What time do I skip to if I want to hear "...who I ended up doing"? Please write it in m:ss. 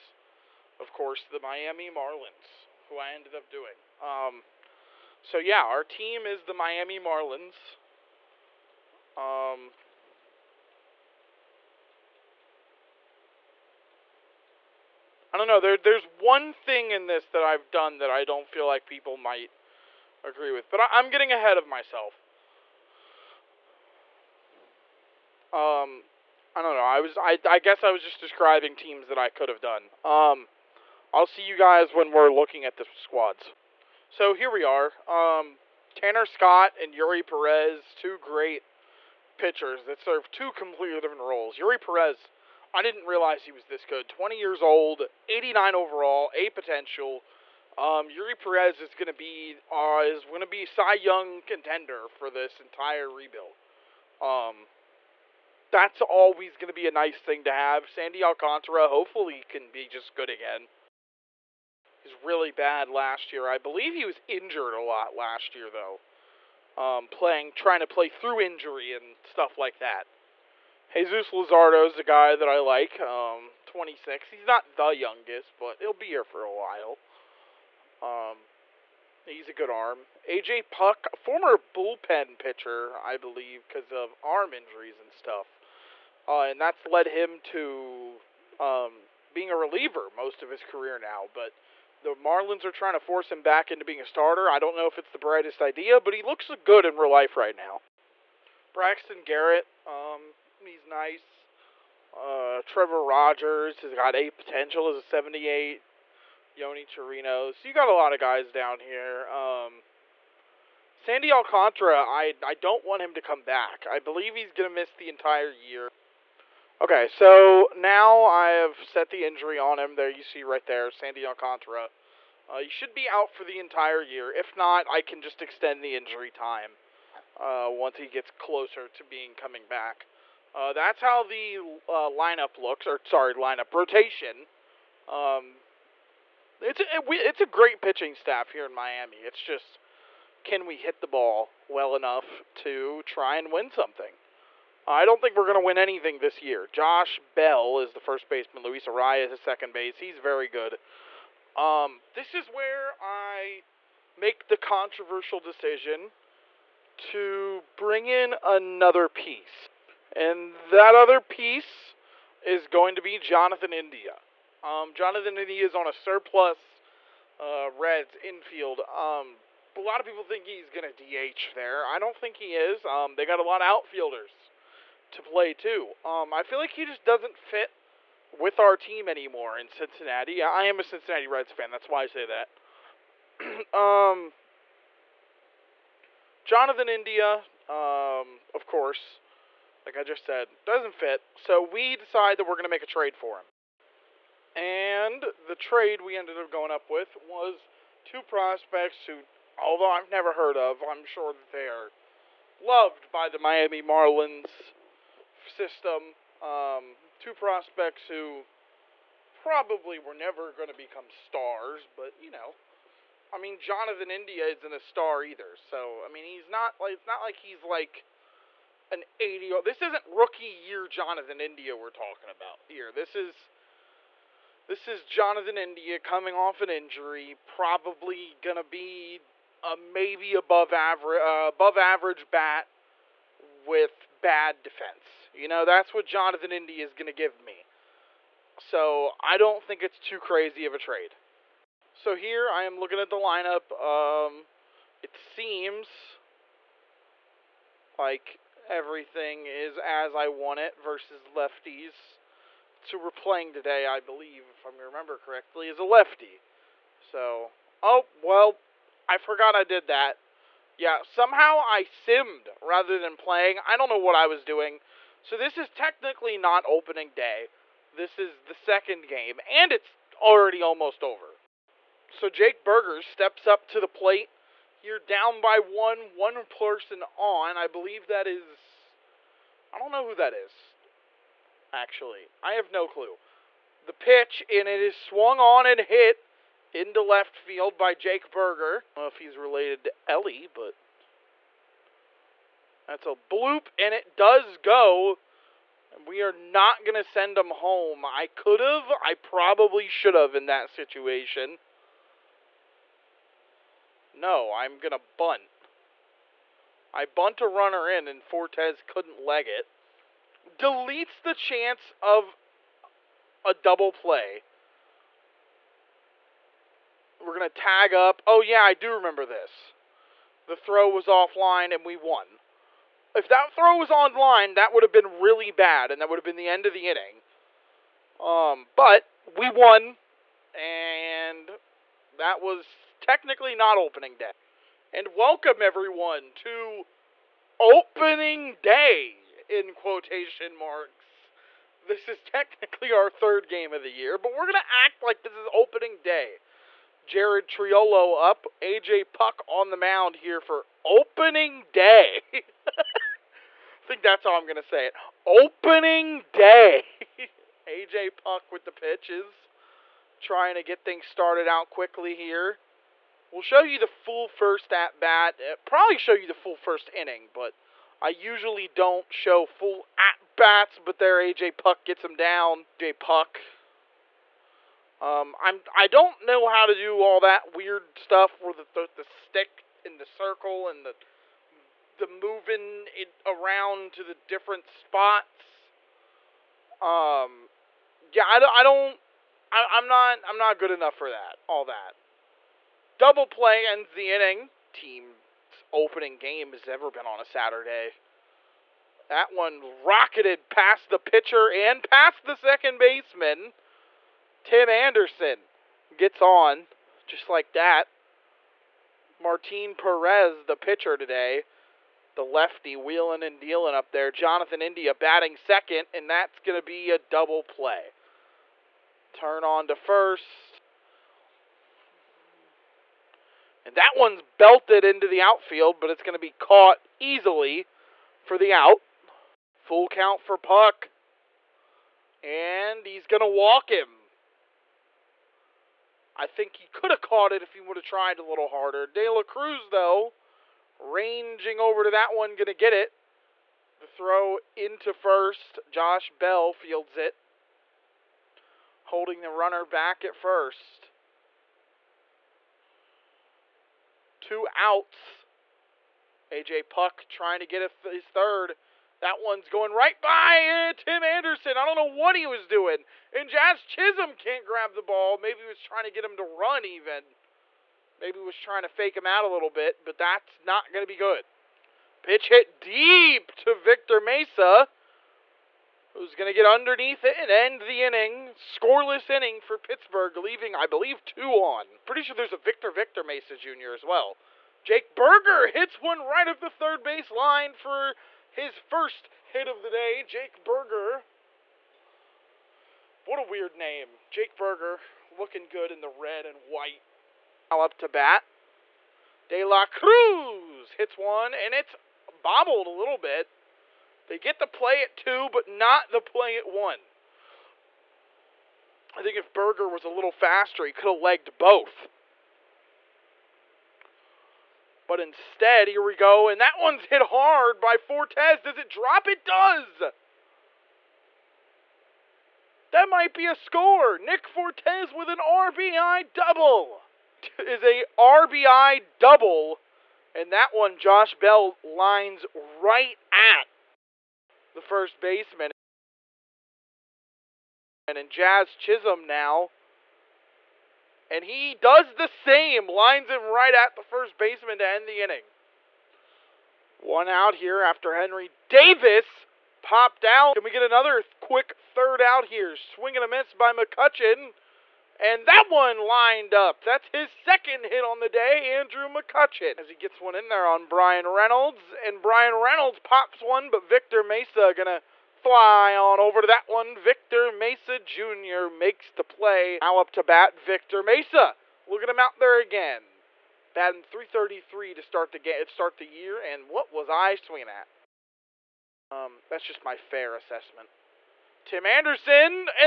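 0:02.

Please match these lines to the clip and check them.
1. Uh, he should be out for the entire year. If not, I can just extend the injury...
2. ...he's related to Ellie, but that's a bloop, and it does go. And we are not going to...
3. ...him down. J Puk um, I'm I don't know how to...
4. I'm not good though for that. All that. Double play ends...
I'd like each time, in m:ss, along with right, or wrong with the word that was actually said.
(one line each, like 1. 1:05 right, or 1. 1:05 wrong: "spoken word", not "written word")
1. 2:02 right
2. 4:49 right
3. 6:12 right
4. 6:30 wrong: "enough", not "though".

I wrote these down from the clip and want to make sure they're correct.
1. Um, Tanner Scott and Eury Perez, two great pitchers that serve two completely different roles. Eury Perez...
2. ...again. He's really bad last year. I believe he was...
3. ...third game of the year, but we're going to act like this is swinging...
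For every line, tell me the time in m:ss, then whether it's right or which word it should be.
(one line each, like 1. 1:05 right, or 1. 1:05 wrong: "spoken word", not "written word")
1. 0:35 right
2. 1:00 right
3. 5:43 wrong: "opening", not "swinging".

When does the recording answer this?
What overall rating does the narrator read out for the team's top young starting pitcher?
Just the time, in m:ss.
0:45.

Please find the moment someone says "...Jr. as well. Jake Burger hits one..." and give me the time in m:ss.
8:03.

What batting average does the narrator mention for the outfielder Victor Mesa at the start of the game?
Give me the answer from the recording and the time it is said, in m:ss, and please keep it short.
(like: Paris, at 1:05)
333, at 9:33.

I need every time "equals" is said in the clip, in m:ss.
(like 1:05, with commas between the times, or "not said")
not said.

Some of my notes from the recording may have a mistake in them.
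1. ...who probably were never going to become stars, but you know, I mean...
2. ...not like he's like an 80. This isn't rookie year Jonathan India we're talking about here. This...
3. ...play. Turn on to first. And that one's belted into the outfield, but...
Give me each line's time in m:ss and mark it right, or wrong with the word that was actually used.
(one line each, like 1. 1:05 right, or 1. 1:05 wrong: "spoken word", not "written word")
1. 3:28 right
2. 3:37 right
3. 6:57 right.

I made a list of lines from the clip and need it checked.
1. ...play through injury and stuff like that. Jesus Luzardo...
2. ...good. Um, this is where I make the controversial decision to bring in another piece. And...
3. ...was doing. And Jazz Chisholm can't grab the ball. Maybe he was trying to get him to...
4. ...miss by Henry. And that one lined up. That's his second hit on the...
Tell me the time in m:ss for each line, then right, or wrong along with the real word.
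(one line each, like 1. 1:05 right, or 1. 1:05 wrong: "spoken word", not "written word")
1. 1:07 right
2. 2:30 right
3. 7:42 right
4. 9:13 wrong: "McCutchen", not "Henry".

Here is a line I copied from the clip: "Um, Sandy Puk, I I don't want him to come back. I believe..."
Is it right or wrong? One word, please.
wrong.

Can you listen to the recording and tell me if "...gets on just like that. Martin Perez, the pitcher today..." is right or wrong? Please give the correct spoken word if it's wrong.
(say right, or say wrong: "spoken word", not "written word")
right.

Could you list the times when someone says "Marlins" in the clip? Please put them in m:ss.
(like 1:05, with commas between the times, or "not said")
0:01, 0:06, 1:32, 3:23.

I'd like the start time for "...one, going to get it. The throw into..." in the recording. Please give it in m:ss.
7:22.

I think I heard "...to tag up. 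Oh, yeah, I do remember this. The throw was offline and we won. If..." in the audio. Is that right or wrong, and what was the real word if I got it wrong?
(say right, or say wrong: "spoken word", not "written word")
right.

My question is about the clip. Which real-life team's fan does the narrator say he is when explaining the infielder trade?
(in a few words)
Cincinnati Reds.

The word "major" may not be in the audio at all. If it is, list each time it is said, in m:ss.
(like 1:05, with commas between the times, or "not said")
not said.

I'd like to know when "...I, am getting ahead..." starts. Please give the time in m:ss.
0:20.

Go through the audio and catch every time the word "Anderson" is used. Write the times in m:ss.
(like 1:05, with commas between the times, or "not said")
6:44, 7:41, 9:41.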